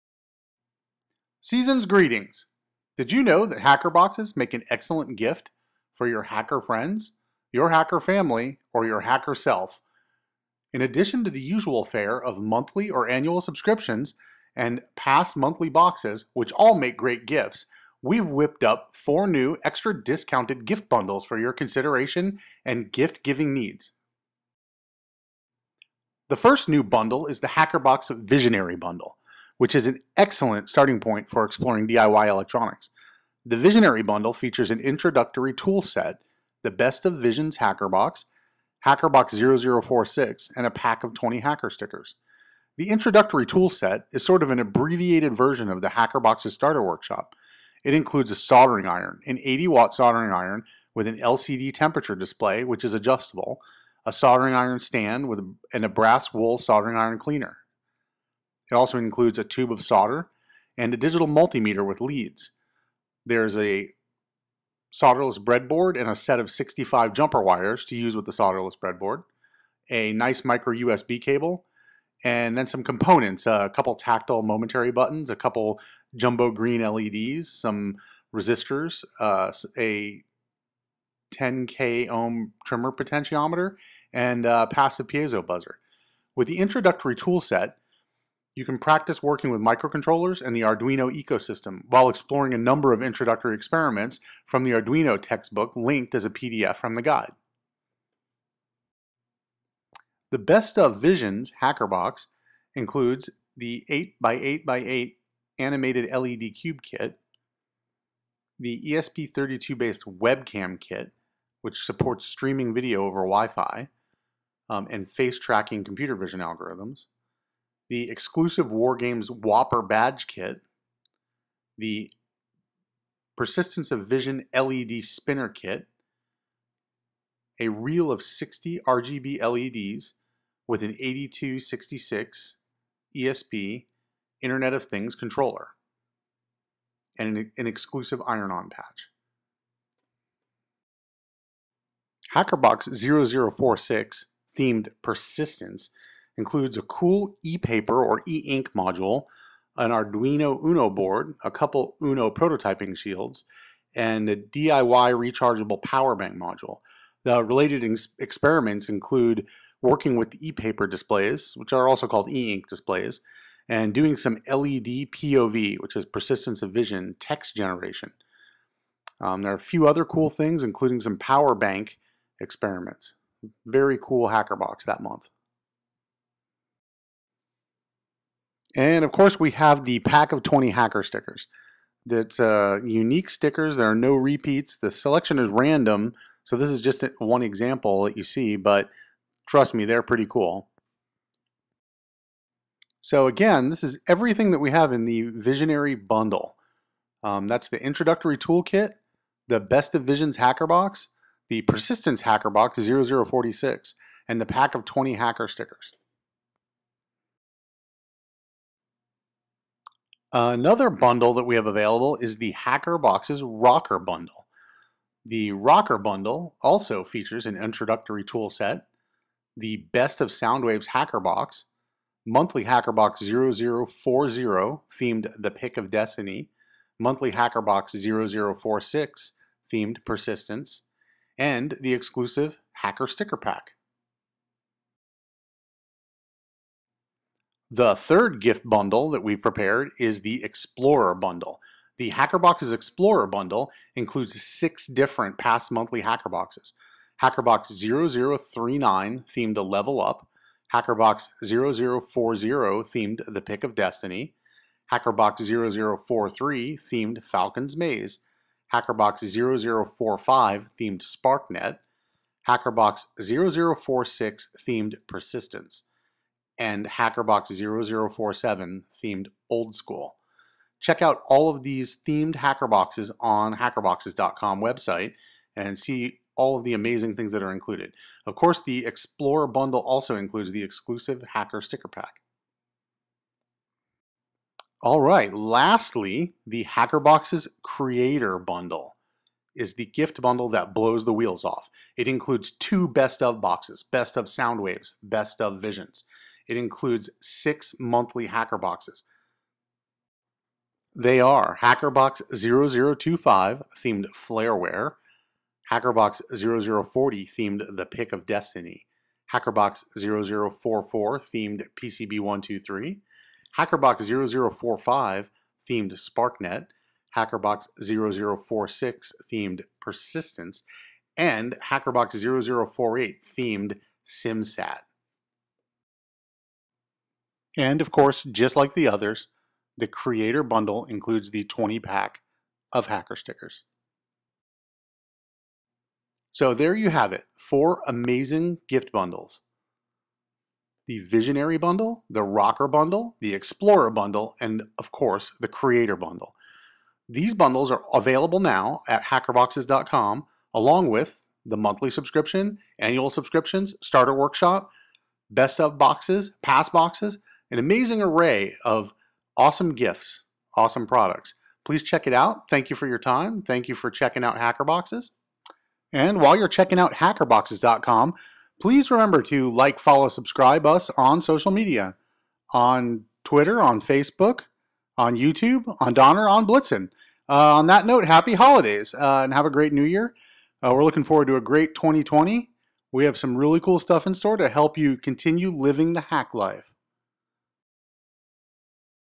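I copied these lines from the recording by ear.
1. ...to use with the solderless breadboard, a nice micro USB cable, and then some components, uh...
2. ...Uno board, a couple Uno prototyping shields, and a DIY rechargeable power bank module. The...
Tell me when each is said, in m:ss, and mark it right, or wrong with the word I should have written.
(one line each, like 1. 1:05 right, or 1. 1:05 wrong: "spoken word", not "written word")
1. 1:07 right
2. 2:30 right.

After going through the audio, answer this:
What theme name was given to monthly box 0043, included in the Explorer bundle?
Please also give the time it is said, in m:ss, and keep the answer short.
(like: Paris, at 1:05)
Falcon's Maze, at 4:17.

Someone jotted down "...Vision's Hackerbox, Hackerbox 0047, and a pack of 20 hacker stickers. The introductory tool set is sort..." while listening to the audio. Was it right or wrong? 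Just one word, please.
wrong.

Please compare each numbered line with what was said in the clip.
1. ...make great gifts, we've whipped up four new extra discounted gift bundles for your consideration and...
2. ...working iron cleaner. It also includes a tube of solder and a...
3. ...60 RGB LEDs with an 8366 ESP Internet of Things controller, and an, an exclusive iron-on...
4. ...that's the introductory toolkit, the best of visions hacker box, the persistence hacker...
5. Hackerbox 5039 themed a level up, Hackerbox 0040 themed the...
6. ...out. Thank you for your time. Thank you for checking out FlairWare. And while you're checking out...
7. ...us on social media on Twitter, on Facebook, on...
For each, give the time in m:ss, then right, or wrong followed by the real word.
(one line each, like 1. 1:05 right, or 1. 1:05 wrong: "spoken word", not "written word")
1. 0:16 right
2. 0:56 wrong: "soldering", not "working"
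3. 2:08 wrong: "8266", not "8366"
4. 3:17 right
5. 4:07 wrong: "0039", not "5039"
6. 6:02 wrong: "Hackerboxes", not "FlairWare"
7. 6:10 right.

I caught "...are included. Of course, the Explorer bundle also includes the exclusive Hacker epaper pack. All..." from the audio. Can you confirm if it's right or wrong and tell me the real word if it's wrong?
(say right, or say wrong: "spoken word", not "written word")
wrong: "sticker", not "epaper".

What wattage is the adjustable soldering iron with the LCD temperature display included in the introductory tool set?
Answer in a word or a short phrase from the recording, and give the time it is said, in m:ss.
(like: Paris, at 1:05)
80 watt, at 0:49.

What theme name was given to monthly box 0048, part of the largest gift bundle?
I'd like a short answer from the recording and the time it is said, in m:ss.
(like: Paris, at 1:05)
SimSat, at 5:24.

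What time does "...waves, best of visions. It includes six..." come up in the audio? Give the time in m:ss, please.
4:54.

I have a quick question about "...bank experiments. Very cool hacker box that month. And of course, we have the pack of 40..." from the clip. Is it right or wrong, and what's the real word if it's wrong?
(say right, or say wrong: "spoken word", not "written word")
wrong: "20", not "40".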